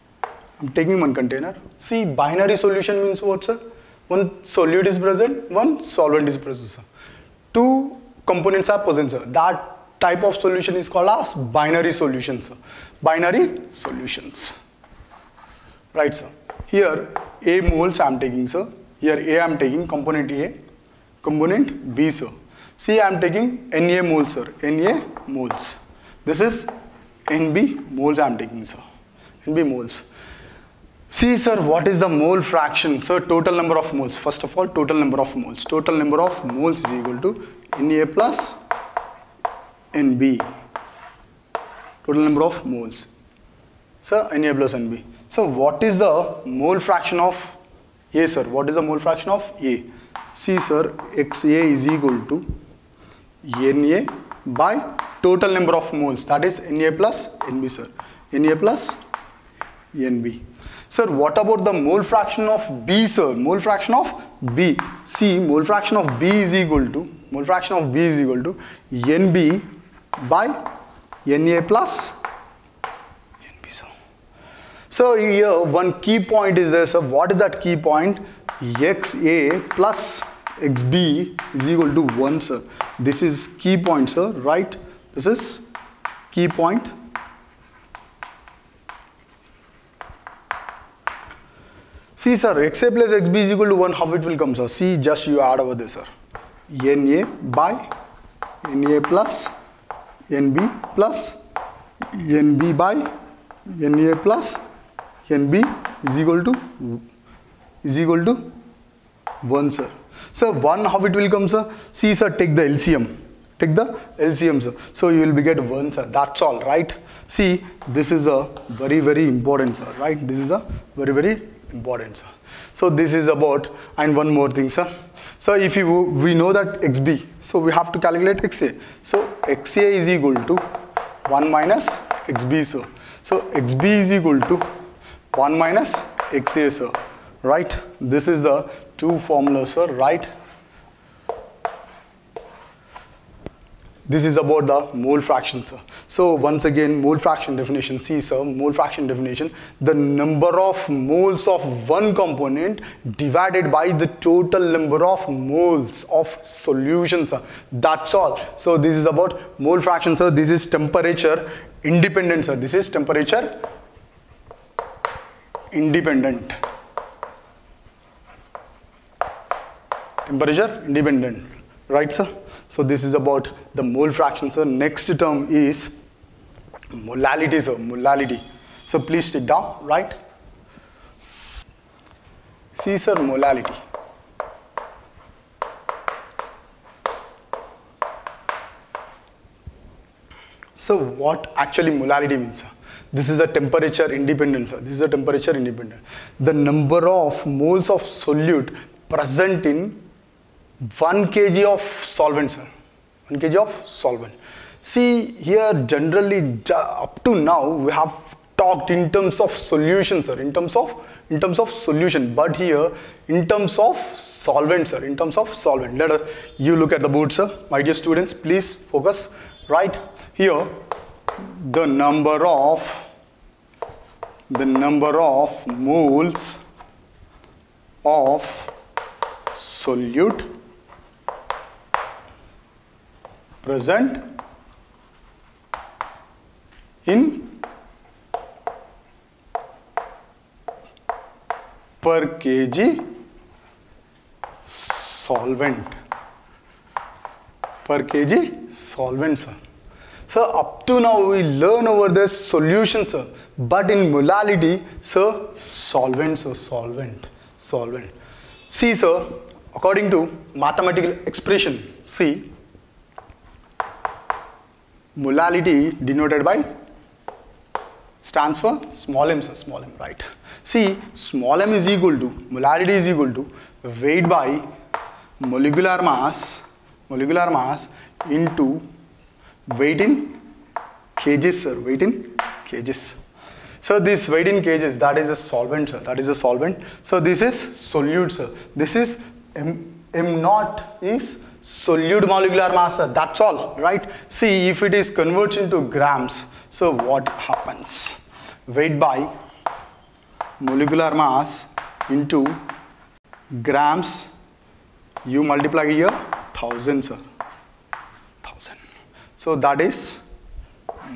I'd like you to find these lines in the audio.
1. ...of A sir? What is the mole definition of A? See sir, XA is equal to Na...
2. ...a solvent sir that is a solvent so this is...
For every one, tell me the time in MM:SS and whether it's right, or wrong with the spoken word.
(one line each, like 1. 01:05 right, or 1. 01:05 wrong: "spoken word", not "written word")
1. 00:47 wrong: "fraction", not "definition"
2. 04:45 right.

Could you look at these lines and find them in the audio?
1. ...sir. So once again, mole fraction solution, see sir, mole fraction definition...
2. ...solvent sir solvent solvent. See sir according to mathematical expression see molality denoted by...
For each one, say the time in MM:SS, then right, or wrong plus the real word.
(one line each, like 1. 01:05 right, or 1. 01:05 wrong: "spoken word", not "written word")
1. 02:25 wrong: "definition", not "solution"
2. 04:15 right.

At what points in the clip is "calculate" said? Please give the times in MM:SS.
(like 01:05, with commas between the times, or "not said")
02:07.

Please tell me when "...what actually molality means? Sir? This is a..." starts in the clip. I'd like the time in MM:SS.
03:10.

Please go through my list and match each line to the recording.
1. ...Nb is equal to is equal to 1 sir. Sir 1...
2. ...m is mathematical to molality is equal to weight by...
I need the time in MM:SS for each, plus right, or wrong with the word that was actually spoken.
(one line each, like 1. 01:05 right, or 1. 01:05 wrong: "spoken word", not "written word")
1. 01:45 right
2. 04:31 wrong: "equal", not "mathematical".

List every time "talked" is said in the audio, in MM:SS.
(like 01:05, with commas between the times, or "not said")
03:28.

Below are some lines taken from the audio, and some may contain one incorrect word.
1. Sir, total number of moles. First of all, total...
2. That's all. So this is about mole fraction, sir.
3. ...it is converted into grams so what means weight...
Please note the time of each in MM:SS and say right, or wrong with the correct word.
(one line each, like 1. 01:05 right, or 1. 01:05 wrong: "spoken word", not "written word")
1. 00:32 right
2. 02:37 right
3. 04:54 wrong: "happens", not "means".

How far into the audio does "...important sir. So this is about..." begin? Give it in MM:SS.
02:01.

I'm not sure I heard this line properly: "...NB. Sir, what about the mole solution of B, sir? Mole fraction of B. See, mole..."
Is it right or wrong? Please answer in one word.
wrong.